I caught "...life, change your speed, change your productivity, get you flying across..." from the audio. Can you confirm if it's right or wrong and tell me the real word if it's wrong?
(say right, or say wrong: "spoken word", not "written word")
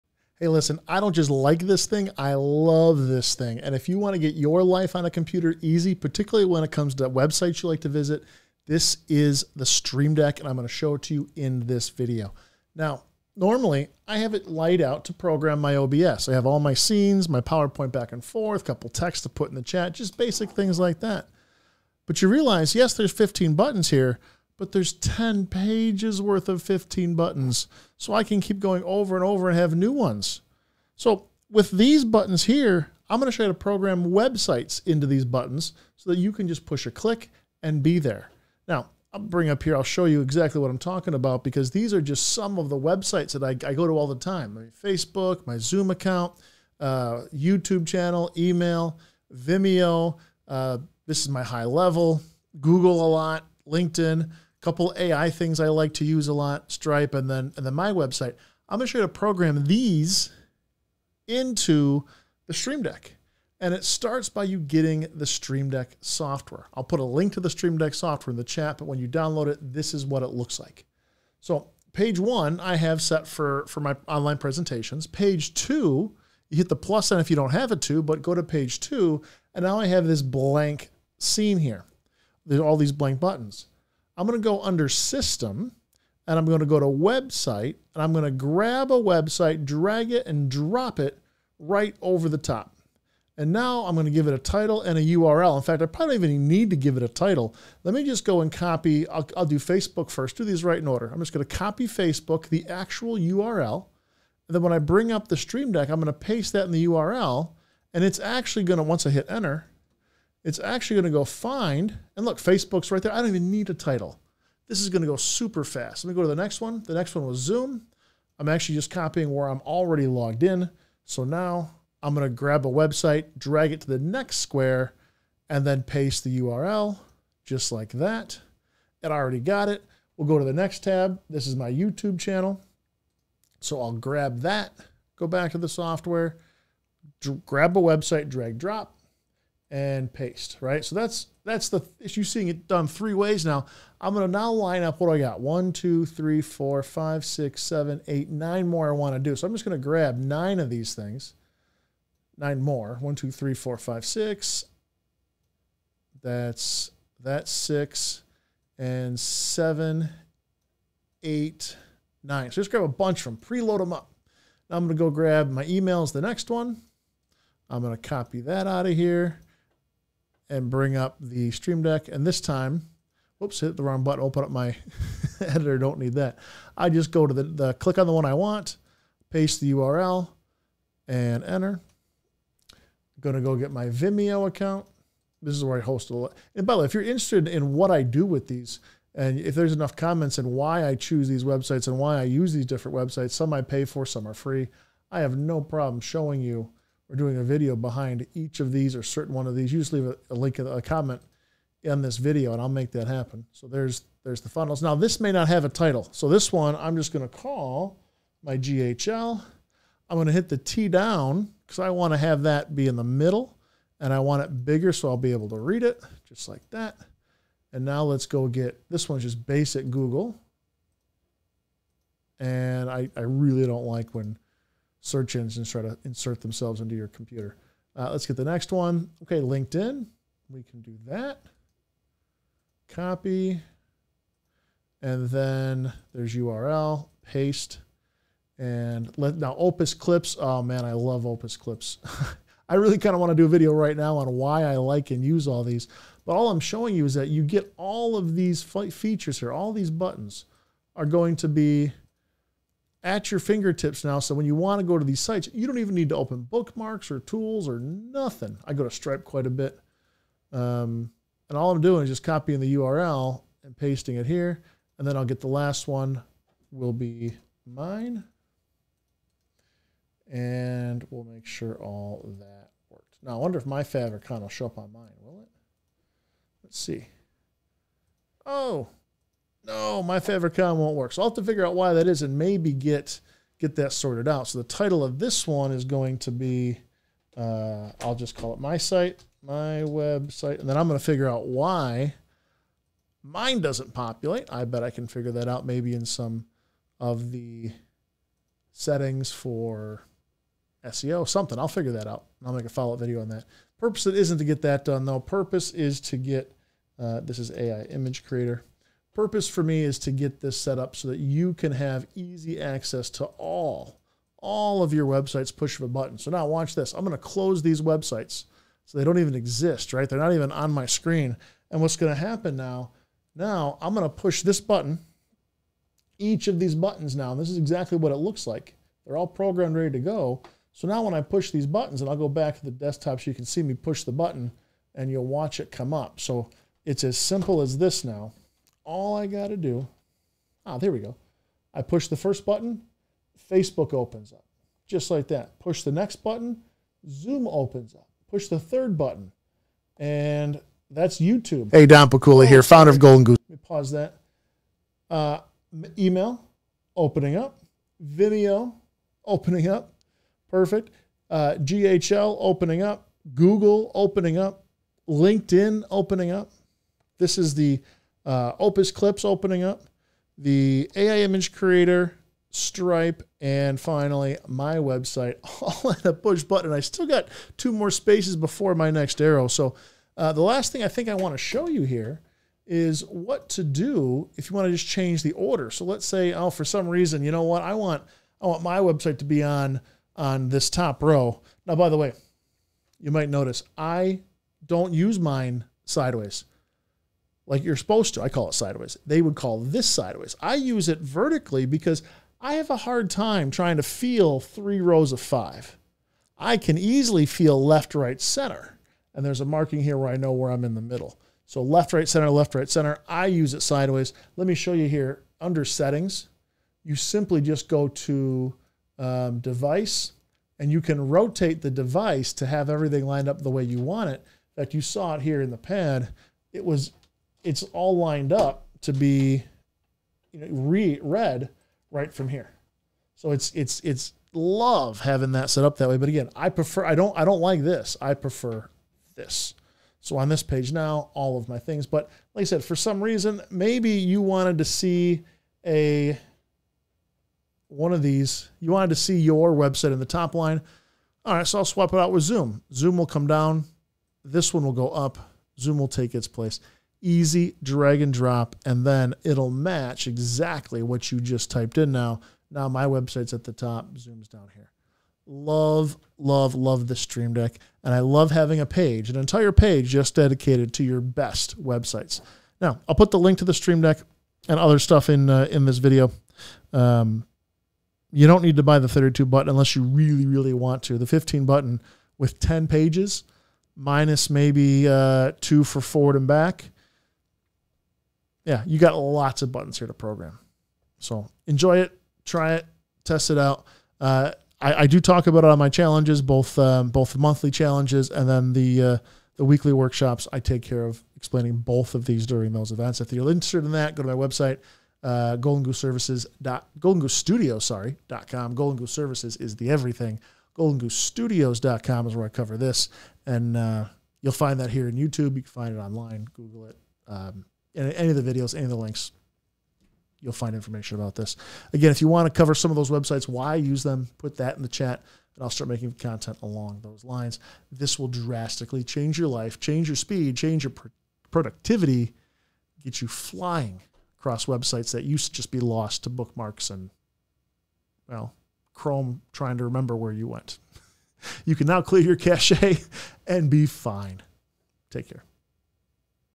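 right.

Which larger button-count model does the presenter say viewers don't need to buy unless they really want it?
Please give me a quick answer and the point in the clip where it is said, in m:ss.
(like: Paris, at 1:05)
32 button, at 7:58.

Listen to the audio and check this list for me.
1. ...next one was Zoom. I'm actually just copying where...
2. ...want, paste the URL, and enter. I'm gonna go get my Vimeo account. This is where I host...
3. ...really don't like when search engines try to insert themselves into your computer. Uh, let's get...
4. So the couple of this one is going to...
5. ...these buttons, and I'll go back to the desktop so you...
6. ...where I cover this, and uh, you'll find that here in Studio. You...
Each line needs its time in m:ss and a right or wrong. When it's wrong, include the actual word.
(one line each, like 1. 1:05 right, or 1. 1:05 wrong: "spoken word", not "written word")
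1. 1:56 right
2. 2:58 right
3. 3:43 right
4. 4:44 wrong: "title", not "couple"
5. 5:31 right
6. 8:32 wrong: "YouTube", not "Studio".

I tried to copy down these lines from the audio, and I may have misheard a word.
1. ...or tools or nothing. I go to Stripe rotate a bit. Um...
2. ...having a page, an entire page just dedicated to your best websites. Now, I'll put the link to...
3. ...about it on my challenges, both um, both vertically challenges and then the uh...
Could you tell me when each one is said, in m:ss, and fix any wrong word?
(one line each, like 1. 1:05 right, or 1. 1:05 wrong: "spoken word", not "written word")
1. 4:17 wrong: "quite", not "rotate"
2. 7:48 right
3. 8:15 wrong: "monthly", not "vertically".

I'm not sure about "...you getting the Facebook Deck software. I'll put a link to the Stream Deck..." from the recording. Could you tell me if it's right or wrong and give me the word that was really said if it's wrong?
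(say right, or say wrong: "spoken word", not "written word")
wrong: "Stream", not "Facebook".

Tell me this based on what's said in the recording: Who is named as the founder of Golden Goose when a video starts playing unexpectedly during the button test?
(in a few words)
Don Pikula.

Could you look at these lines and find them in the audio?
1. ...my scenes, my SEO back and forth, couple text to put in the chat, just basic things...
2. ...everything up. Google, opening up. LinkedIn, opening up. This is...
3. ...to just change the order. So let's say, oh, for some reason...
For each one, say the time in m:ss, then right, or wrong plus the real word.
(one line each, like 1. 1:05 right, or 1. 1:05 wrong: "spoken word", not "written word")
1. 0:16 wrong: "PowerPoint", not "SEO"
2. 6:02 wrong: "opening", not "everything"
3. 6:24 right.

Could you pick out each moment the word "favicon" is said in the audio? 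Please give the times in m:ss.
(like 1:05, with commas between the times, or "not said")
4:33, 4:40.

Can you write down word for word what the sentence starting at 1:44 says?
And then when I bring up the Stream Deck, I'm going to paste that in the URL.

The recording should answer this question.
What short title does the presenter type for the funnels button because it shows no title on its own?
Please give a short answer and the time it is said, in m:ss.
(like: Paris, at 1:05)
my GHL, at 3:28.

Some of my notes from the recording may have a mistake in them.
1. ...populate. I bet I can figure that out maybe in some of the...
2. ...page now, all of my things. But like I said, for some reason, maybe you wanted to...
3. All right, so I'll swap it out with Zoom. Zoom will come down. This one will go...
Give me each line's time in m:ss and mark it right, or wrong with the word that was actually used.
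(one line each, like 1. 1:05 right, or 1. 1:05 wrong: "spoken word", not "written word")
1. 4:53 right
2. 7:20 right
3. 7:31 right.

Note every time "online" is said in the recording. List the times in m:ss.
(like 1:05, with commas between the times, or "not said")
1:14, 8:35.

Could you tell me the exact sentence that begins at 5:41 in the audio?
I push the first button, Facebook opens up, just like that.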